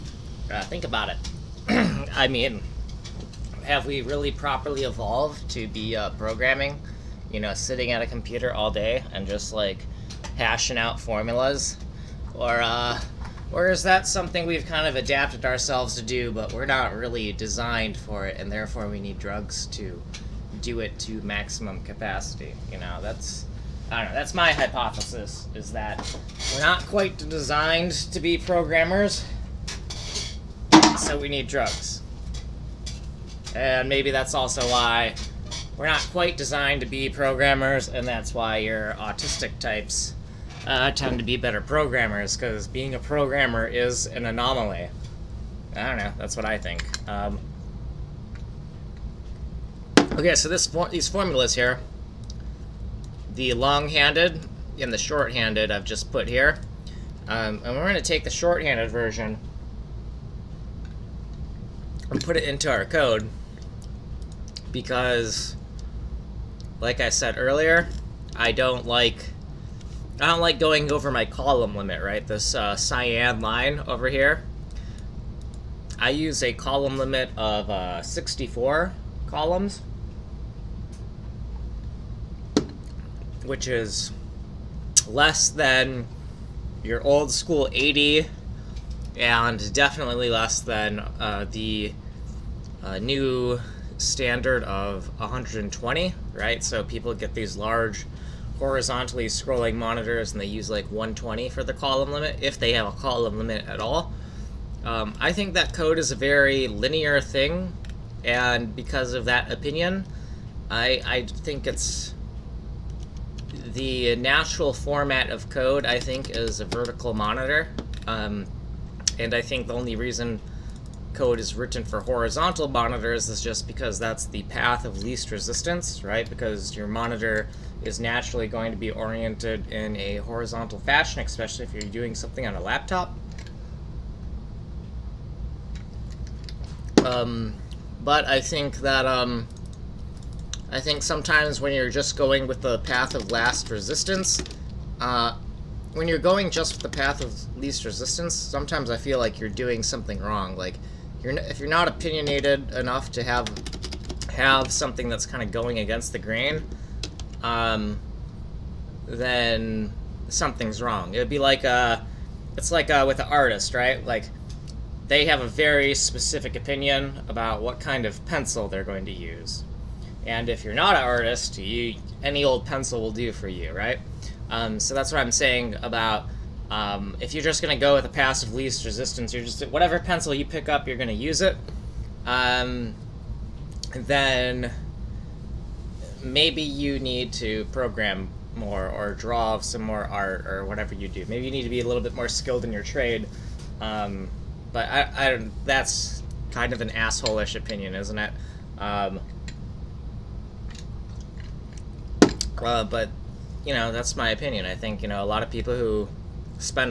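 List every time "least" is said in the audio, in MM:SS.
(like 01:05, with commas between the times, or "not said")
02:05, 02:27, 02:58.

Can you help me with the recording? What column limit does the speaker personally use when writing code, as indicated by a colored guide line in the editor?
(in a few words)
64.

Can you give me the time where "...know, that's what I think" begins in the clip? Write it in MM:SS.
00:45.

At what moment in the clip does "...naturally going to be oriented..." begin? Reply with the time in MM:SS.
02:07.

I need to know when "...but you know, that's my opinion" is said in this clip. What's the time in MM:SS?
03:22.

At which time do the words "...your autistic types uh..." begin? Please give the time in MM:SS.
00:38.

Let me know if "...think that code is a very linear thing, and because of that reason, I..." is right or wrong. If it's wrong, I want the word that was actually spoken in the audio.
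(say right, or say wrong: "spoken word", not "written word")
wrong: "opinion", not "reason".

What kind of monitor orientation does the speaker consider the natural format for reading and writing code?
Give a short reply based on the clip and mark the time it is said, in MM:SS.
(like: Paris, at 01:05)
vertical monitor, at 01:56.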